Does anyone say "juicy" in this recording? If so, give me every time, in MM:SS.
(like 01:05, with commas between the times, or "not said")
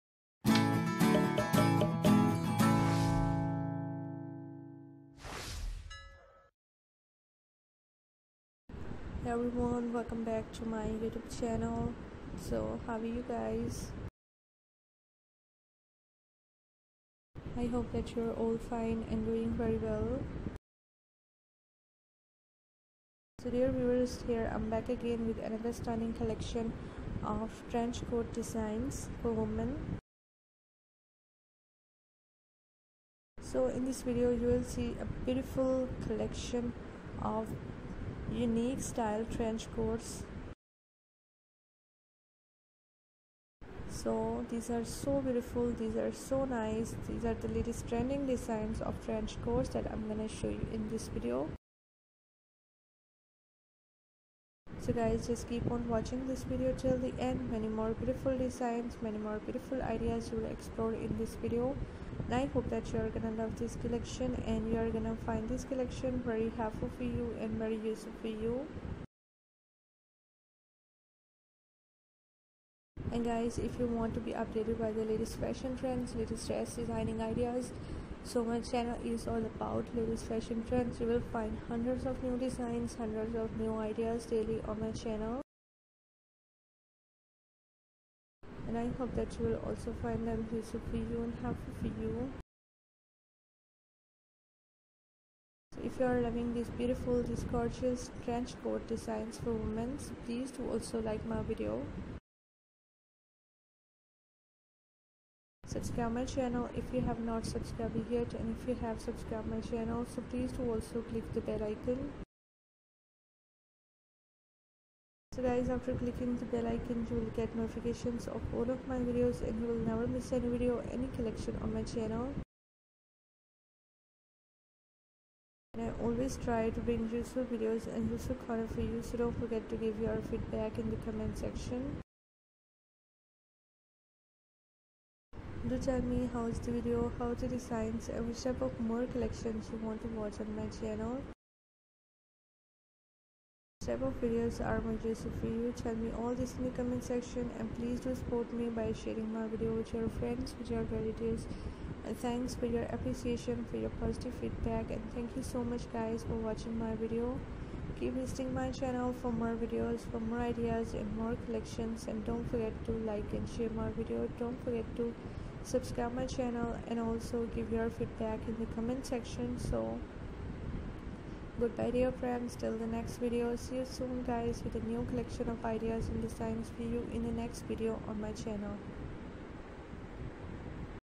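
02:24.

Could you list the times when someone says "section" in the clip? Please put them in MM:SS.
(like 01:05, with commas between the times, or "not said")
02:11, 02:27, 02:49.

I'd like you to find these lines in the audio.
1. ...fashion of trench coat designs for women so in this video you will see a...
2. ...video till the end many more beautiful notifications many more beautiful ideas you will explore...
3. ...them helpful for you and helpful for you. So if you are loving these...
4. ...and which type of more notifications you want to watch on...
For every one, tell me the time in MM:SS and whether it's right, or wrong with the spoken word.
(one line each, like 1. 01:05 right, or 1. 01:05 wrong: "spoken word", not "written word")
1. 00:26 wrong: "collection", not "fashion"
2. 00:56 wrong: "designs", not "notifications"
3. 01:30 wrong: "useful", not "helpful"
4. 02:18 wrong: "collections", not "notifications".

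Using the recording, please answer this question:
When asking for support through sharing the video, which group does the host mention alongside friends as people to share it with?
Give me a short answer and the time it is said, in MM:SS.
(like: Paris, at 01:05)
relatives, at 02:30.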